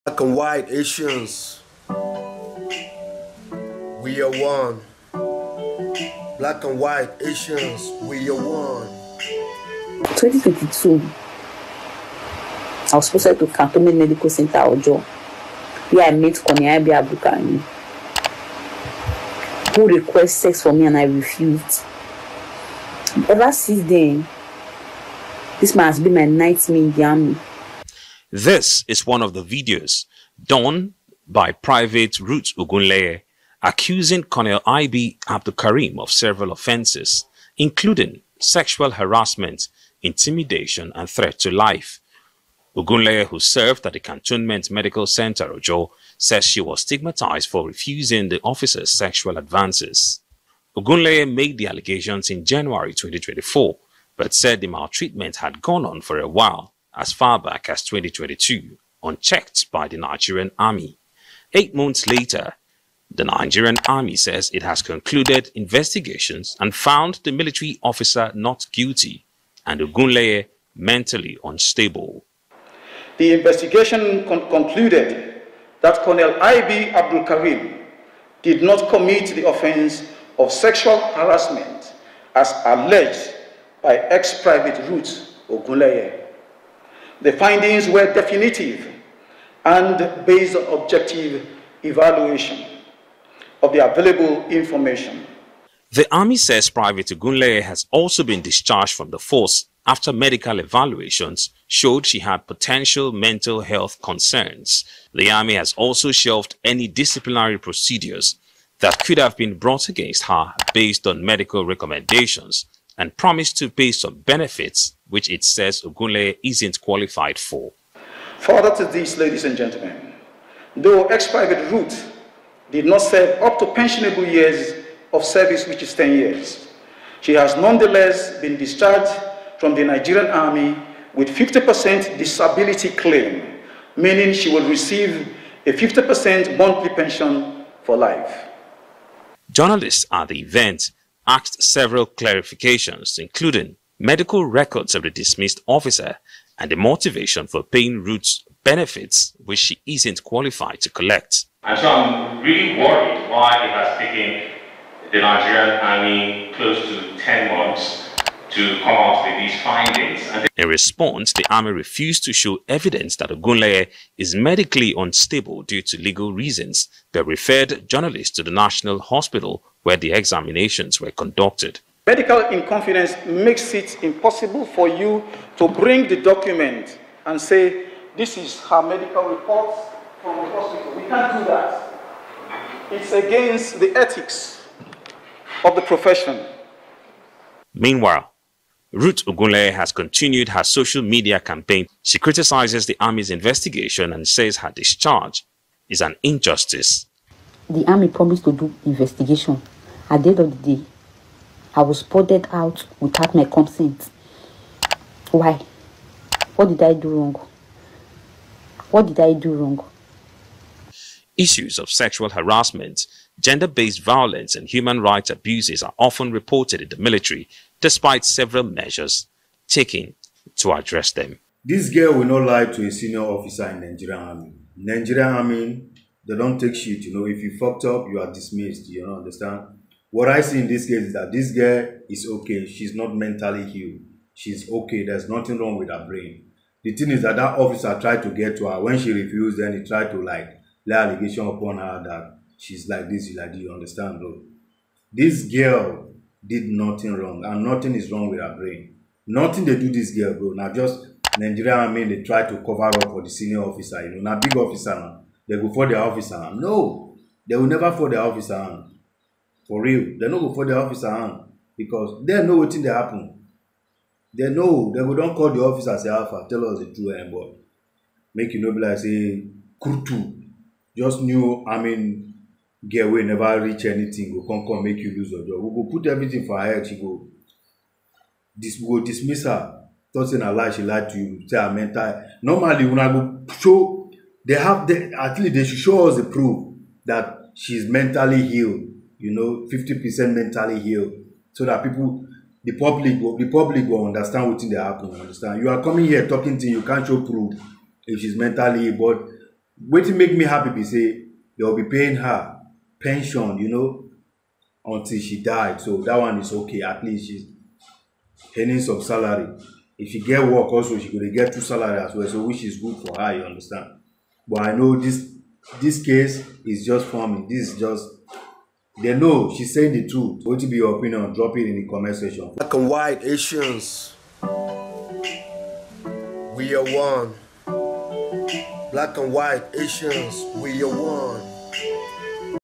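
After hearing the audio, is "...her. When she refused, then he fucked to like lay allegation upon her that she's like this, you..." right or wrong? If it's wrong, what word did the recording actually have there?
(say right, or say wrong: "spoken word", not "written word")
wrong: "tried", not "fucked".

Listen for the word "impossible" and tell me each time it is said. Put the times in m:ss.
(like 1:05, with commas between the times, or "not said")
2:54.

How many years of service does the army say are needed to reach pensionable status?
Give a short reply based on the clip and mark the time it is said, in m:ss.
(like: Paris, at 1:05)
10 years, at 2:05.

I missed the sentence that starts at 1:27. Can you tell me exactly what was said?
The findings were definitive and based on objective evaluation of the available information.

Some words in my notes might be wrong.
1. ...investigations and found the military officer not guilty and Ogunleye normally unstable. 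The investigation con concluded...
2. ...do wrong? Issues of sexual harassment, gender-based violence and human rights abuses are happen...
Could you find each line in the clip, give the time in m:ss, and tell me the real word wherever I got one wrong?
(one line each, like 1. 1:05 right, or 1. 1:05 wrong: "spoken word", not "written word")
1. 1:05 wrong: "mentally", not "normally"
2. 3:29 wrong: "often", not "happen".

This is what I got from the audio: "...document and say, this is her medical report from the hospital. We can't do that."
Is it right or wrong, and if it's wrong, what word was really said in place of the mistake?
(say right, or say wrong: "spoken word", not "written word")
right.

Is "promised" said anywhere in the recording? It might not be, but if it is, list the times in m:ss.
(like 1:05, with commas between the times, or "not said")
1:53, 3:18.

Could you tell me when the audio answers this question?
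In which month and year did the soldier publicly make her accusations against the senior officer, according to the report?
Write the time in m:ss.
0:52.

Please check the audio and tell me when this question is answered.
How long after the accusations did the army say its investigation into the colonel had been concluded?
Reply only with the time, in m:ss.
1:01.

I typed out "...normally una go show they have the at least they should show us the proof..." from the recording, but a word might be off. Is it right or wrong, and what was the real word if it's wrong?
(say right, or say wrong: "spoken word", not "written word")
right.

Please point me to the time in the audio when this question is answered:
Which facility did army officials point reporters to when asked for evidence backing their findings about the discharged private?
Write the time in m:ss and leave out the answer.
2:48.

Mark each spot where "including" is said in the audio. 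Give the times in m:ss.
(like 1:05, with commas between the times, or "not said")
0:37, 2:23.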